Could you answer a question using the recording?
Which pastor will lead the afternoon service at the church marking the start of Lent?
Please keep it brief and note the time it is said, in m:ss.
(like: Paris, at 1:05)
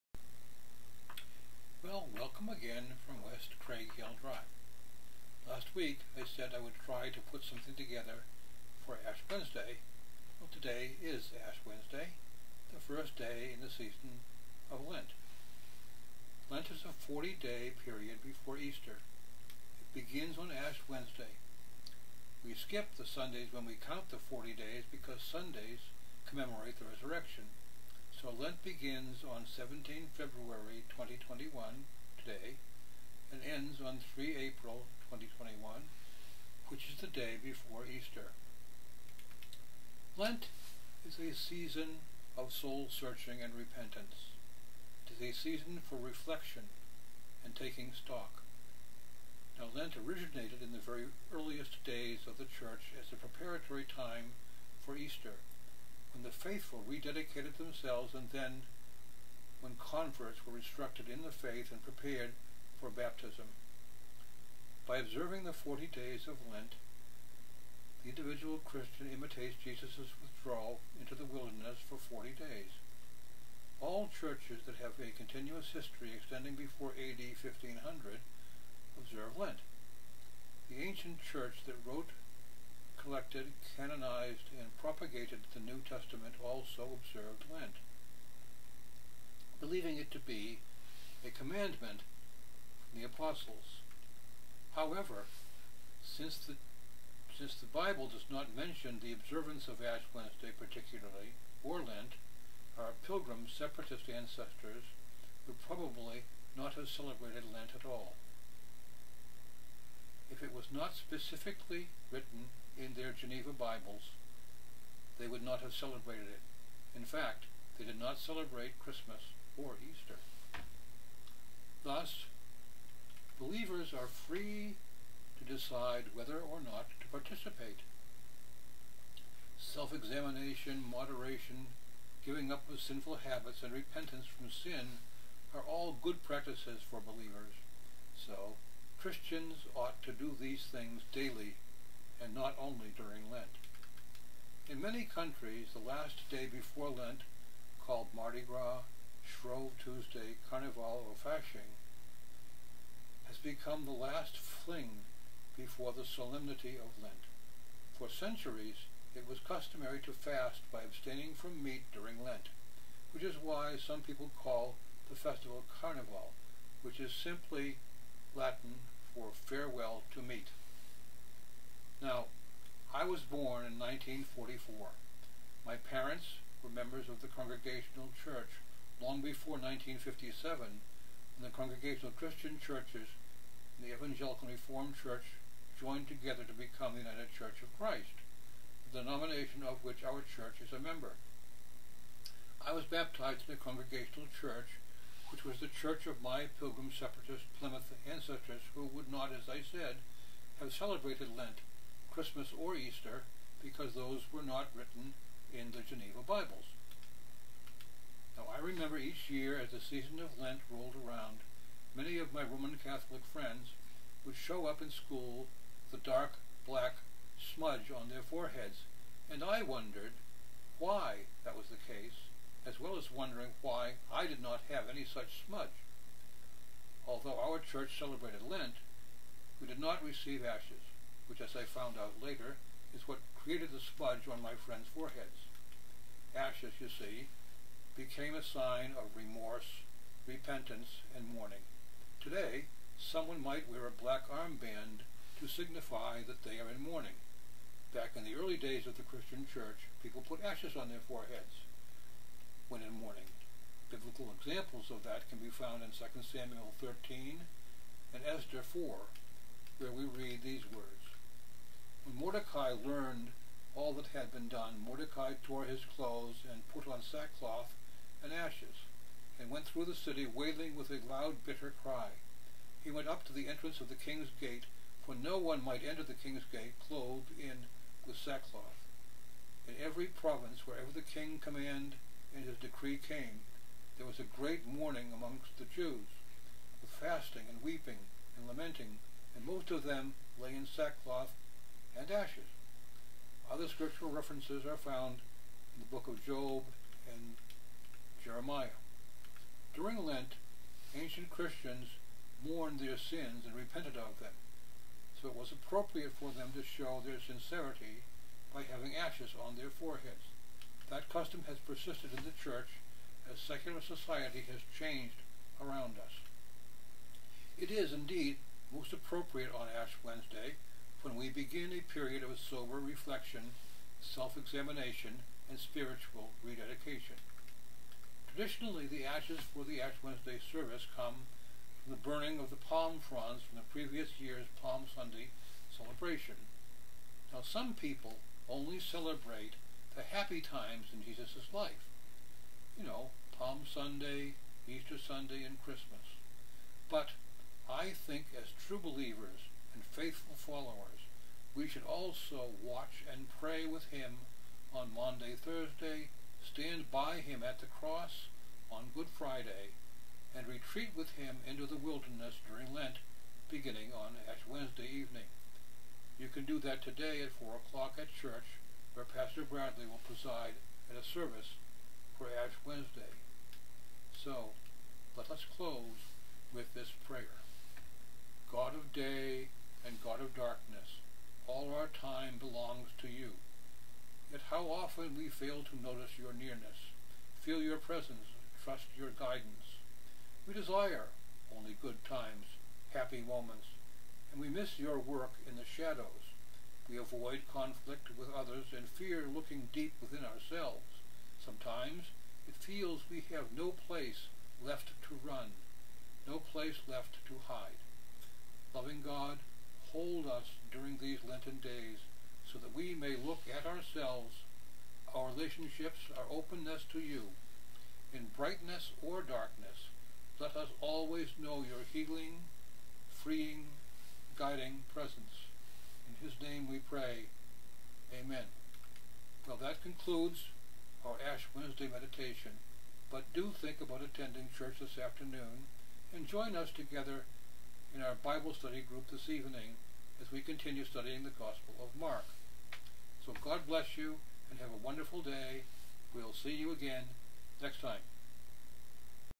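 Pastor Bradley, at 6:09.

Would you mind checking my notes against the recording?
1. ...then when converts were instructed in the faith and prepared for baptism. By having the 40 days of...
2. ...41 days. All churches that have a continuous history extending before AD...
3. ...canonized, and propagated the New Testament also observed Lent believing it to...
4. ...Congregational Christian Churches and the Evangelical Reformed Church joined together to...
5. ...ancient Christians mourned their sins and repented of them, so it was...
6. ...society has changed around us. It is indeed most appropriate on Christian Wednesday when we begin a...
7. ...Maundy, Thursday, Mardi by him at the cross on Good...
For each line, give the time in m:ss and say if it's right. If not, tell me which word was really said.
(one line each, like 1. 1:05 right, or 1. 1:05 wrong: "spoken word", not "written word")
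1. 0:58 wrong: "observing", not "having"
2. 1:12 wrong: "40", not "41"
3. 1:23 right
4. 3:01 right
5. 5:00 right
6. 5:13 wrong: "Ash", not "Christian"
7. 5:54 wrong: "Stand", not "Mardi".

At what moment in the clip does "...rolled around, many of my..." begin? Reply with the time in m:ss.
3:30.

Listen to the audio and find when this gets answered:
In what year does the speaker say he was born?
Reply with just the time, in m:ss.
2:53.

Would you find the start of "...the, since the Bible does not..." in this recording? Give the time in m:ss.
1:36.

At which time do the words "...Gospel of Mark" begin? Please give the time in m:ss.
7:21.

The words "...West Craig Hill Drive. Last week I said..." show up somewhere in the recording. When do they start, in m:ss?
0:03.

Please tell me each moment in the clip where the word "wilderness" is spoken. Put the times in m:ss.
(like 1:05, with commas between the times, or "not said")
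1:11, 6:01.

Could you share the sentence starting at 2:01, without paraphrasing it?
Thus, believers are free to decide whether or not to participate.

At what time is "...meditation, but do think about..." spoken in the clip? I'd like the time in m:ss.
7:11.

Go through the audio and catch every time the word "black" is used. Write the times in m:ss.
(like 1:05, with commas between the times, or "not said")
3:36, 4:04.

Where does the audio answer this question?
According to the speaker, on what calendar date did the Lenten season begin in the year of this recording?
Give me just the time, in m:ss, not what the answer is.
0:29.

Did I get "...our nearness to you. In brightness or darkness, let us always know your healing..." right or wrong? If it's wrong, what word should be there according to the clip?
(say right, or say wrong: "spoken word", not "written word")
wrong: "openness", not "nearness".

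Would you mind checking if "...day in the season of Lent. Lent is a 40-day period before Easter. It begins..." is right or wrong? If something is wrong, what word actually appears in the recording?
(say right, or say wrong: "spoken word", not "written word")
right.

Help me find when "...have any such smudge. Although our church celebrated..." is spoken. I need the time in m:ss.
3:44.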